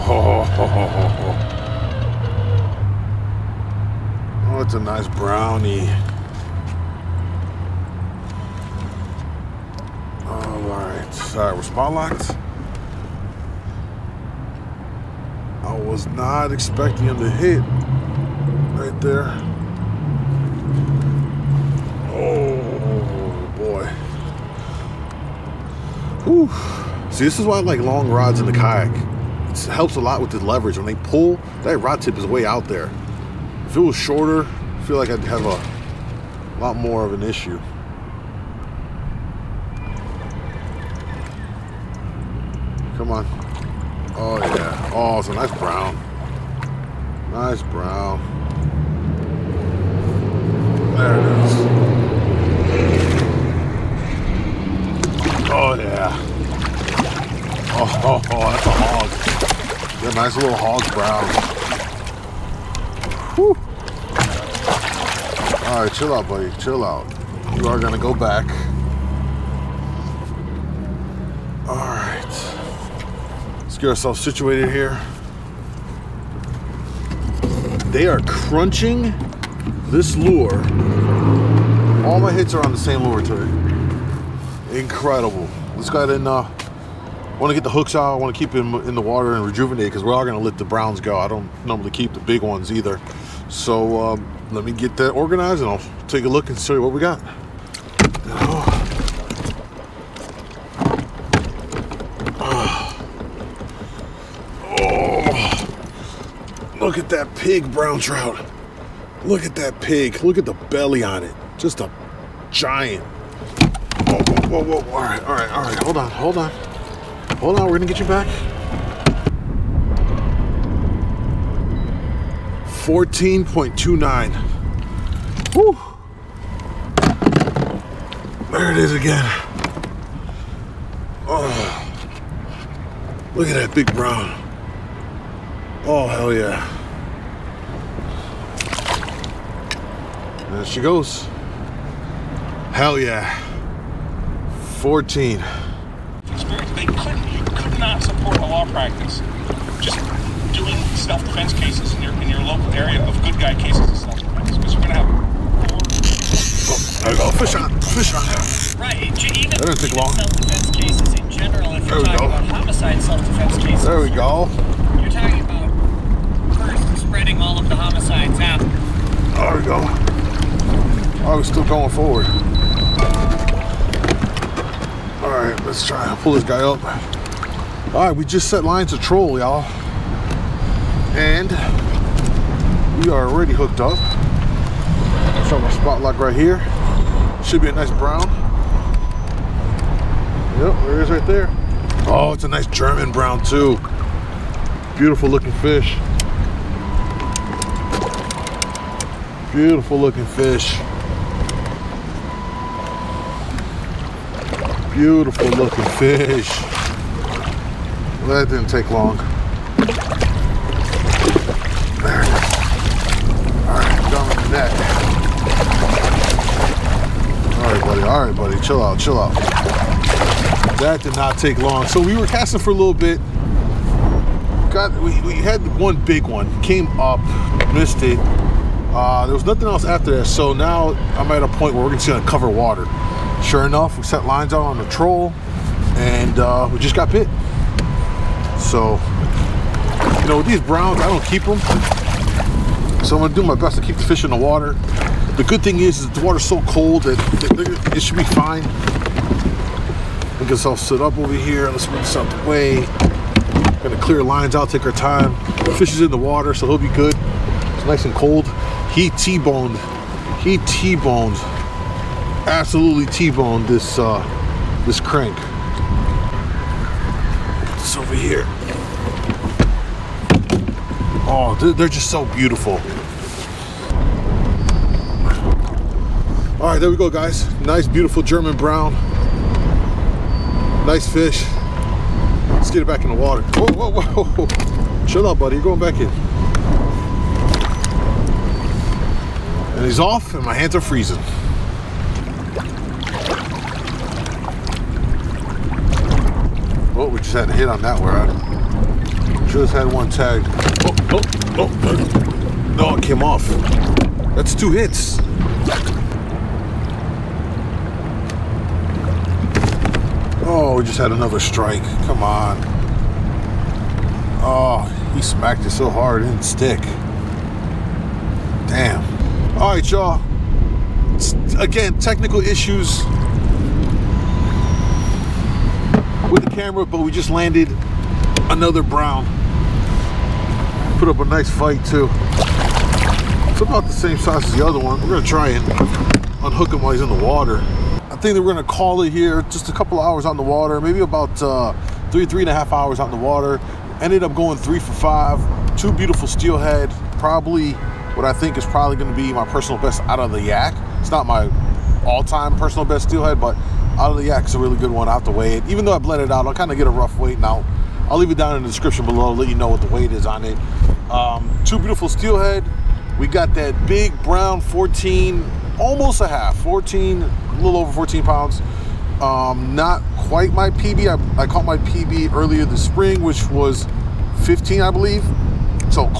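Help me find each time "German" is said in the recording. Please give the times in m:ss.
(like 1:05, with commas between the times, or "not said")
3:12, 4:38.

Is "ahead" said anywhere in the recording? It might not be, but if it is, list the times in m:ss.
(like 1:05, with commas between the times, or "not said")
1:26.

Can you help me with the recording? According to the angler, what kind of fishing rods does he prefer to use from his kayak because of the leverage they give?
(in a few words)
Long rods.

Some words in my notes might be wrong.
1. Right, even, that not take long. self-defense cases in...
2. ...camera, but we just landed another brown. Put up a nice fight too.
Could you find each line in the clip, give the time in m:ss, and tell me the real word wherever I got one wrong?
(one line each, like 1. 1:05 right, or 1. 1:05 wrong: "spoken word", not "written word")
1. 2:38 right
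2. 5:26 right.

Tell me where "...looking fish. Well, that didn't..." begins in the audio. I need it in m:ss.
3:25.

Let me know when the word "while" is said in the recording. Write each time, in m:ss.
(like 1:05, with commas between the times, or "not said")
5:36.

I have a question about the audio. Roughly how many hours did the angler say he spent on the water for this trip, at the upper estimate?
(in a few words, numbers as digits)
3.5 hours.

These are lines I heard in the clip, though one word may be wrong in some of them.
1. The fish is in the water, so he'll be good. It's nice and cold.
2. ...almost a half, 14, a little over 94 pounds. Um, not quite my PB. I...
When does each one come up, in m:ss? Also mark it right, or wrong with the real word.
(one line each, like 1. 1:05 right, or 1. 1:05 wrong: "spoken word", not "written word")
1. 4:15 right
2. 6:05 wrong: "14", not "94".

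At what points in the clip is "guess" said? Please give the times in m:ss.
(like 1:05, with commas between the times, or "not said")
4:10.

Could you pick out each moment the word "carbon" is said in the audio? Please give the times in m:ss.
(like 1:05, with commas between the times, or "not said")
not said.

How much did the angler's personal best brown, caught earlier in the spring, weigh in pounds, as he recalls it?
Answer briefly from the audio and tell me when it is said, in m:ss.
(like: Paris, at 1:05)
15, at 6:14.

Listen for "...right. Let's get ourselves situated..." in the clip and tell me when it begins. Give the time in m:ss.
1:11.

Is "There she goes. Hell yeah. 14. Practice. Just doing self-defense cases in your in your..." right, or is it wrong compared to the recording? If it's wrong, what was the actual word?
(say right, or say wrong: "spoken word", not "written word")
right.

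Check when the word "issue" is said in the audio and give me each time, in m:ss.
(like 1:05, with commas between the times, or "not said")
0:37, 5:22.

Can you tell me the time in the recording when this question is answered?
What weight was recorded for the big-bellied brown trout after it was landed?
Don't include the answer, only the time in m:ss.
2:02.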